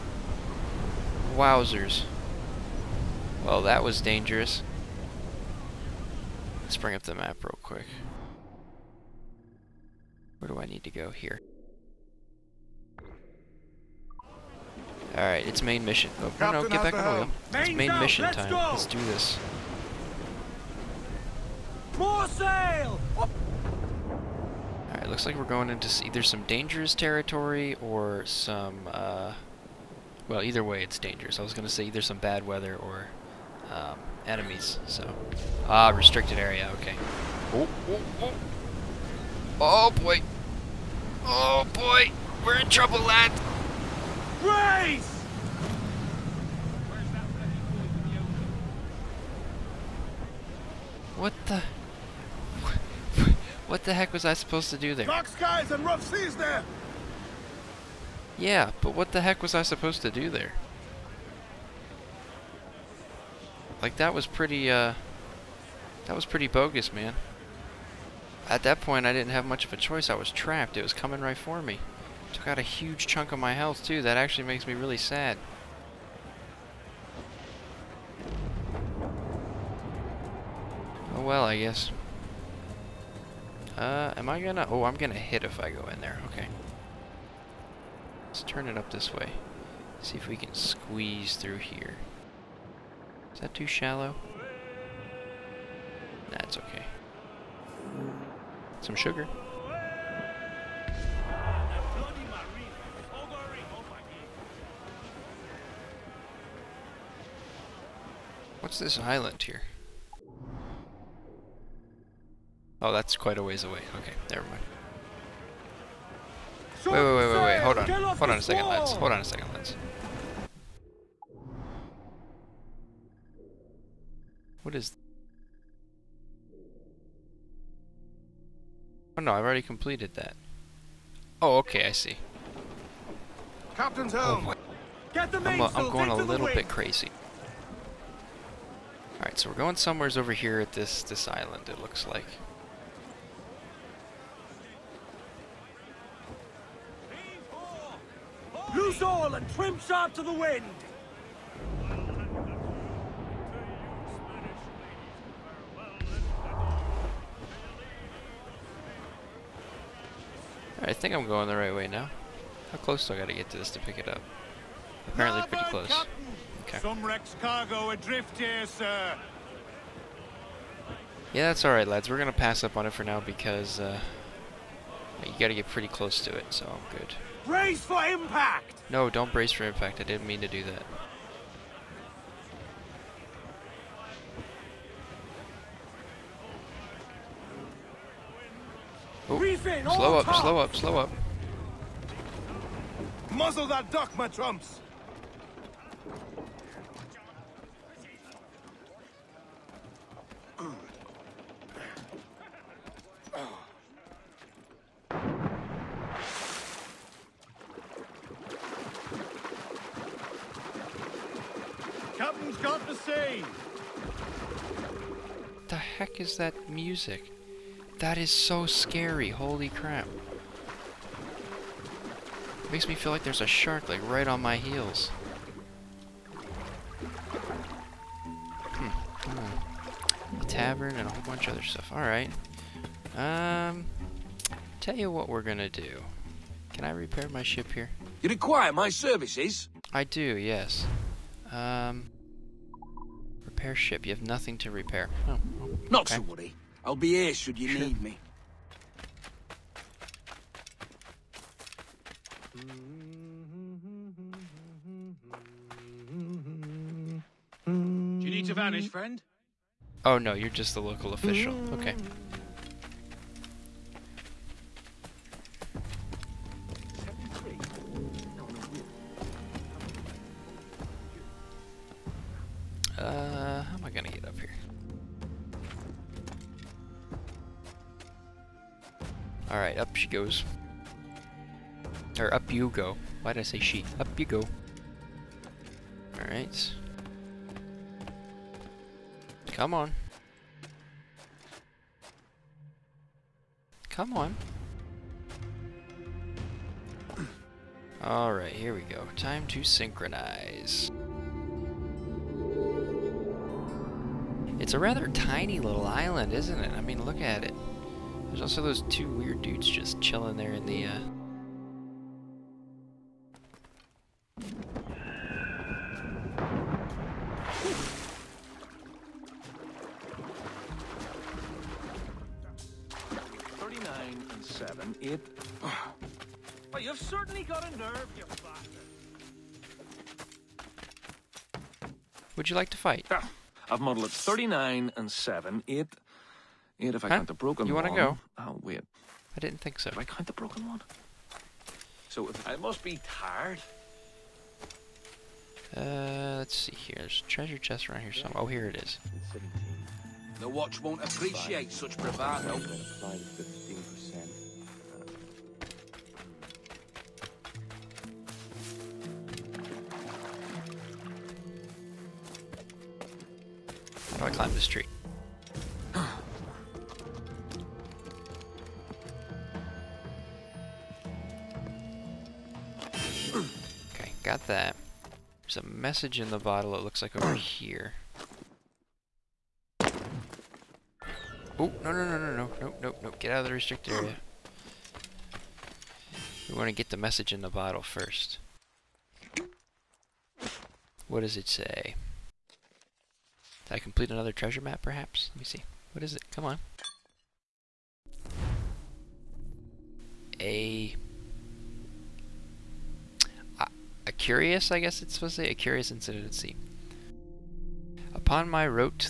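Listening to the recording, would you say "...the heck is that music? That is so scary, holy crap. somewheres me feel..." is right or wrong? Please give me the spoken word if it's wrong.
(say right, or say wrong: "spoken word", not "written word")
wrong: "makes", not "somewheres".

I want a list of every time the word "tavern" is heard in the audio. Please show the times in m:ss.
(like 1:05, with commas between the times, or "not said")
3:50.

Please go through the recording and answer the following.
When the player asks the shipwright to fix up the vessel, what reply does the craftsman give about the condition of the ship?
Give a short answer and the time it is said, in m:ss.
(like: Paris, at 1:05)
Nothing to repair, at 4:04.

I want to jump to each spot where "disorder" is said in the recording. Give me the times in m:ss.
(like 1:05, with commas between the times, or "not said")
not said.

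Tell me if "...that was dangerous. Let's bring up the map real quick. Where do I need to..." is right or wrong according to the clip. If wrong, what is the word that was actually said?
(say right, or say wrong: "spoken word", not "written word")
right.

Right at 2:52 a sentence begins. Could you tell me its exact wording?
We're gonna pass up on it for now because uh, you gotta get pretty close to it, so I'm good.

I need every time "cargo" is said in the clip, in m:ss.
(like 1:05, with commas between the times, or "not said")
2:47.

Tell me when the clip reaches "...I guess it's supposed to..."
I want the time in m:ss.
6:44.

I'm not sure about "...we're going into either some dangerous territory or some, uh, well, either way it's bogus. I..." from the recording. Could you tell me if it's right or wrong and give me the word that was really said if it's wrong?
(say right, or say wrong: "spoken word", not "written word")
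wrong: "dangerous", not "bogus".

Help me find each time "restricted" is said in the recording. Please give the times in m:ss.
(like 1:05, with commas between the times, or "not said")
0:35, 6:23.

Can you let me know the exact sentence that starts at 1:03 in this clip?
Like that was pretty uh that was pretty bogus, man.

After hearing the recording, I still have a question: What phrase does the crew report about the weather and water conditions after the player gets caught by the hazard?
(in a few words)
Dark skies and rough seas.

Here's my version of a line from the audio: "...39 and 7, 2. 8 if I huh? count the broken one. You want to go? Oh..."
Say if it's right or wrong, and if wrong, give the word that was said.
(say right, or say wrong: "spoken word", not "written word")
wrong: "8", not "2".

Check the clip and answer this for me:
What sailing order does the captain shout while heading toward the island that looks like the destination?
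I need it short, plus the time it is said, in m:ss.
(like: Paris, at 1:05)
Loose all and trim sharp to the wind, at 2:28.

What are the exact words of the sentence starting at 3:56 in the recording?
Can I repair my ship here?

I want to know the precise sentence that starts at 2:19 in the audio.
Alright, so we're going somewheres over here at this this island, it looks like.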